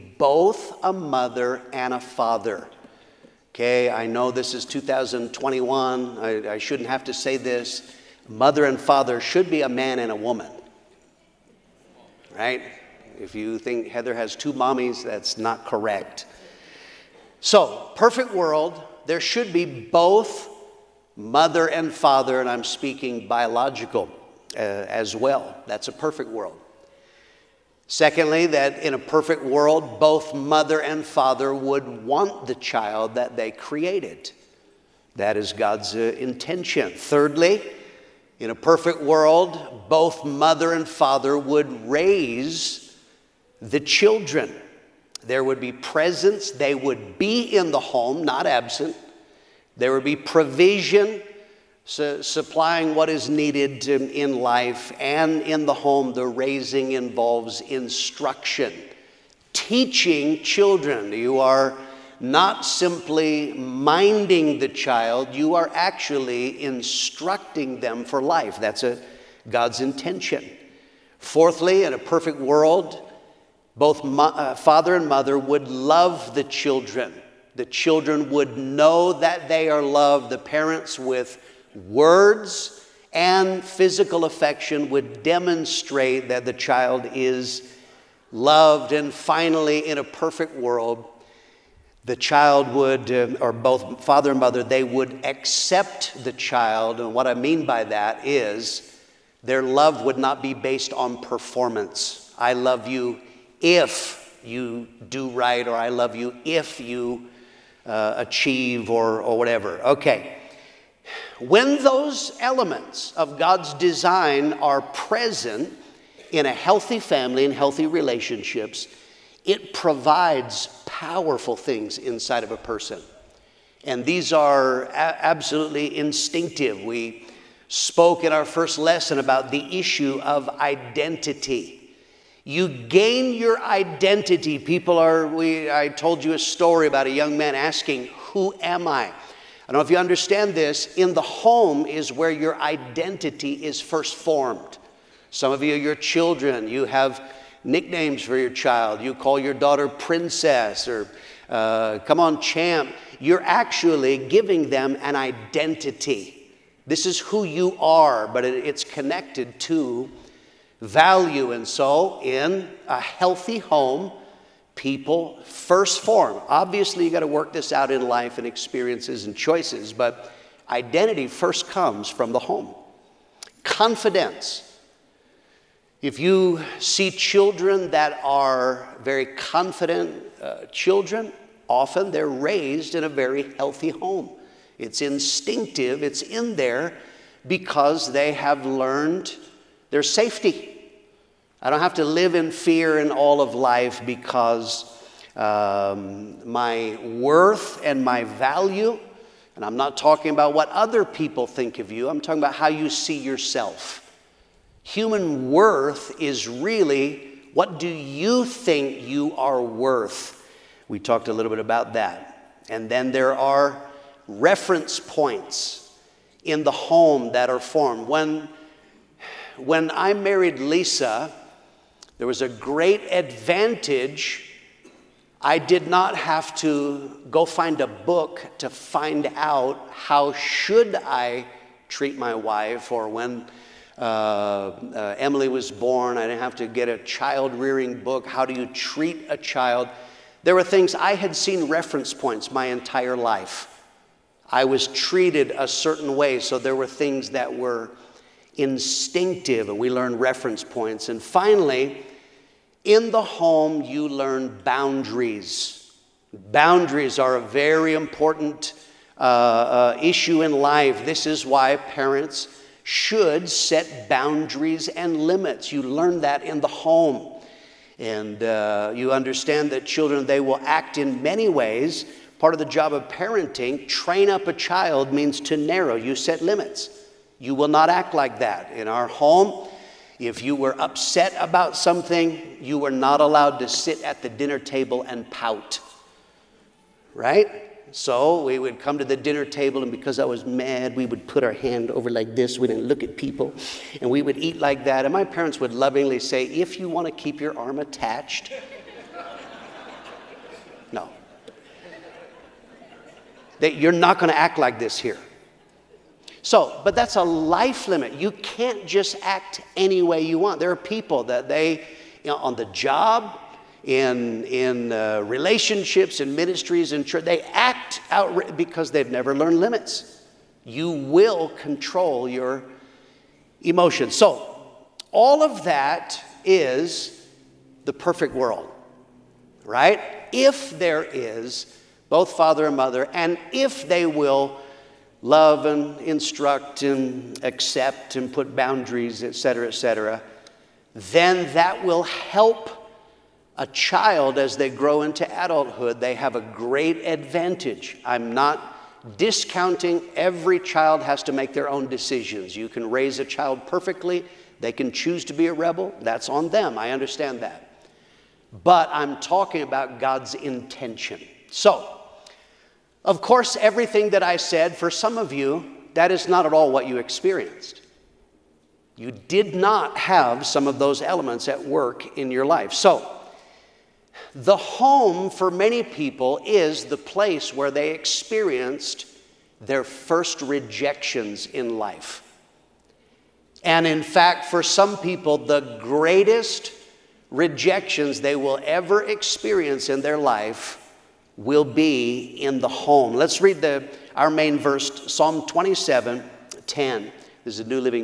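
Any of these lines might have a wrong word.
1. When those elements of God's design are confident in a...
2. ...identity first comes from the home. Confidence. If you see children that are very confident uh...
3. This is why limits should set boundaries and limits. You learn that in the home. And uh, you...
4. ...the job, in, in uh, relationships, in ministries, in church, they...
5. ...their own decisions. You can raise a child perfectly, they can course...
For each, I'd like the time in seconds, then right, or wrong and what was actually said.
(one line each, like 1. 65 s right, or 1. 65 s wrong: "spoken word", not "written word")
1. 111 s wrong: "present", not "confident"
2. 170 s right
3. 261 s wrong: "parents", not "limits"
4. 312 s right
5. 351 s wrong: "choose", not "course".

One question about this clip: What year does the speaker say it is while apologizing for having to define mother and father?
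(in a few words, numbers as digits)
2021.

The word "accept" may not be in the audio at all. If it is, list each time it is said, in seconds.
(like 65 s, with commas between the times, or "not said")
95 s, 337 s.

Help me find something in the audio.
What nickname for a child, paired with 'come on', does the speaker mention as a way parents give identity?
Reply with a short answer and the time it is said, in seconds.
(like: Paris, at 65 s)
champ, at 152 s.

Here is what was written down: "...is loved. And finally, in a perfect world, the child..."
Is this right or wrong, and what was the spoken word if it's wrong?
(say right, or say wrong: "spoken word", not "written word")
right.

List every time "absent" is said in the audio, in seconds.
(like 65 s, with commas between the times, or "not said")
48 s.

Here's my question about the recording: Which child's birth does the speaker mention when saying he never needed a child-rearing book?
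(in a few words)
Emily.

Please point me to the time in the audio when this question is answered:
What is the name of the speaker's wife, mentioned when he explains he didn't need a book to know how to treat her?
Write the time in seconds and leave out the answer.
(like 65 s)
220 s.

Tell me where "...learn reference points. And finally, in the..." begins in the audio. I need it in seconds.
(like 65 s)
249 s.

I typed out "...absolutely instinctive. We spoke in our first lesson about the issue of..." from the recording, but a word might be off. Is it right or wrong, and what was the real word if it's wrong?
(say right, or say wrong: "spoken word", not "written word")
right.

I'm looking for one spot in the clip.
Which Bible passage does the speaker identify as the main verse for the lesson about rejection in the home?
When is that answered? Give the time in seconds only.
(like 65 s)
395 s.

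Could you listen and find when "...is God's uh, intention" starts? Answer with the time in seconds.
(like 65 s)
35 s.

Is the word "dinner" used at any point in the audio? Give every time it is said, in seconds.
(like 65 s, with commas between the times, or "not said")
284 s, 289 s.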